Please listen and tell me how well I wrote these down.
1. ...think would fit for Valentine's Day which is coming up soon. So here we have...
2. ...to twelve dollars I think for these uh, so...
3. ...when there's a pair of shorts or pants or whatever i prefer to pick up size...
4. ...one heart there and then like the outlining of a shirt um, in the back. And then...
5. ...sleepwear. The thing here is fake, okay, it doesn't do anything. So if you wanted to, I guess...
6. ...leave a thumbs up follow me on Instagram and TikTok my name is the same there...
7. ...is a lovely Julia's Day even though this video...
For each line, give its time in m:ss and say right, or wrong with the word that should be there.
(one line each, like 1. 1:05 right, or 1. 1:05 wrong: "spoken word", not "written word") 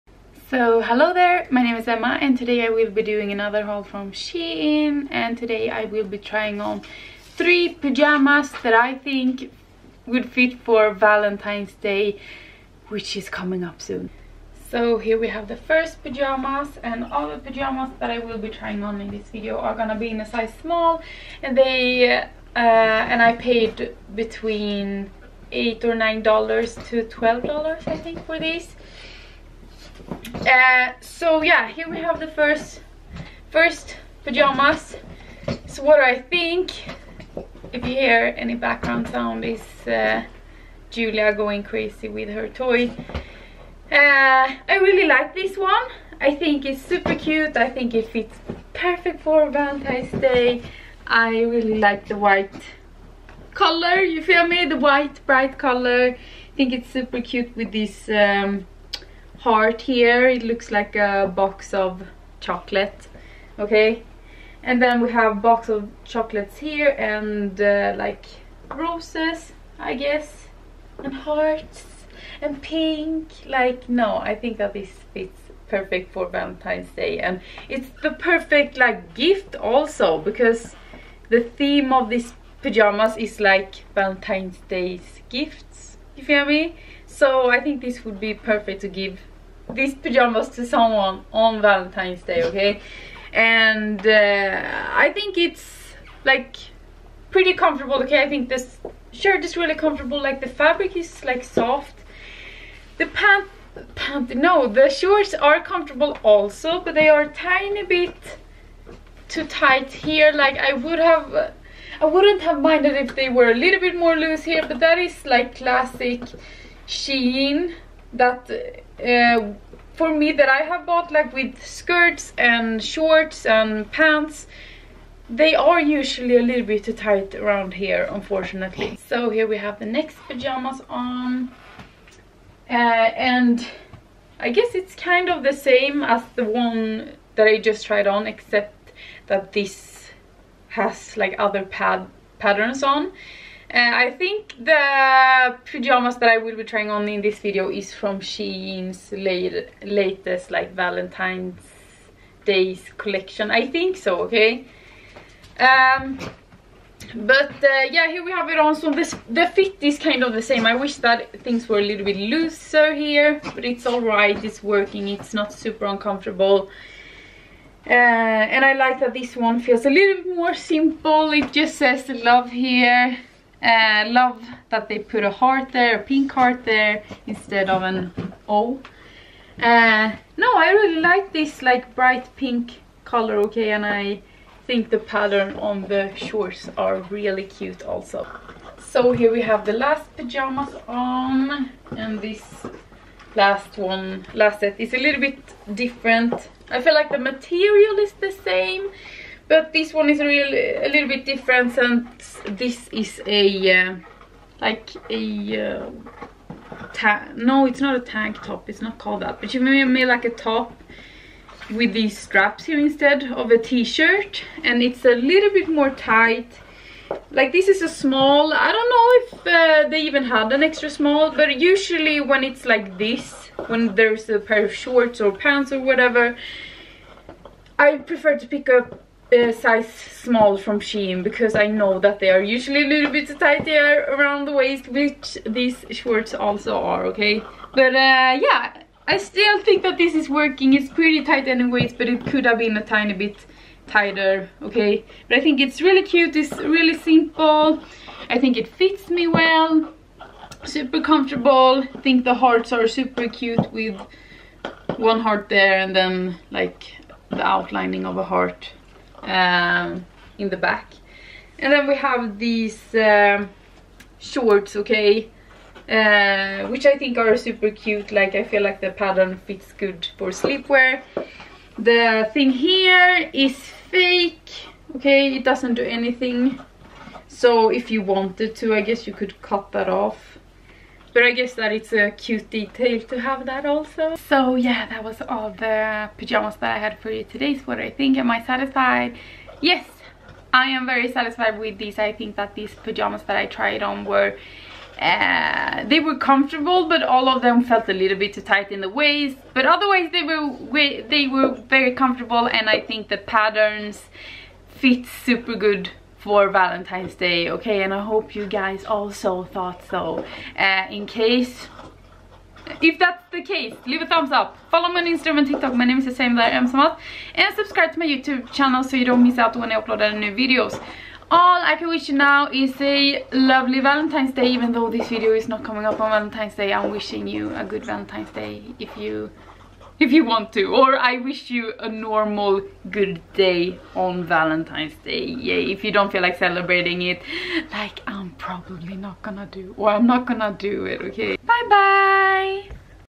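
1. 0:08 right
2. 0:26 right
3. 3:43 right
4. 4:14 wrong: "heart", not "shirt"
5. 4:30 right
6. 5:13 right
7. 5:22 wrong: "Valentine", not "Julia".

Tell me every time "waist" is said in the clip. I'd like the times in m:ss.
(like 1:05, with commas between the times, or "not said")
3:54, 4:58.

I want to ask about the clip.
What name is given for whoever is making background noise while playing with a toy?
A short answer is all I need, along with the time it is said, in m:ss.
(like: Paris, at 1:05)
Julia, at 0:40.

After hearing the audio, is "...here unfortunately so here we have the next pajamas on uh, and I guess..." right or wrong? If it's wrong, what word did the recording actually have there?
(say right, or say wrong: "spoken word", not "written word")
right.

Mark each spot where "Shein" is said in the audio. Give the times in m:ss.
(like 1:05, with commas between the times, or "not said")
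0:04, 1:56, 2:28, 3:50.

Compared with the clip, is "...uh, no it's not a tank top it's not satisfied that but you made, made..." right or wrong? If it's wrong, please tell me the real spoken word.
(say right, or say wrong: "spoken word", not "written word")
wrong: "called", not "satisfied".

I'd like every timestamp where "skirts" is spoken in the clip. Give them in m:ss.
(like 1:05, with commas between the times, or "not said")
2:01.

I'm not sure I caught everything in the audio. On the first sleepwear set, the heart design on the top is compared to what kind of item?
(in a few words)
box of chocolate.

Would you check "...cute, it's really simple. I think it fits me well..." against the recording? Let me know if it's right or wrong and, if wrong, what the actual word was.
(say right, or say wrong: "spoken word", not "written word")
right.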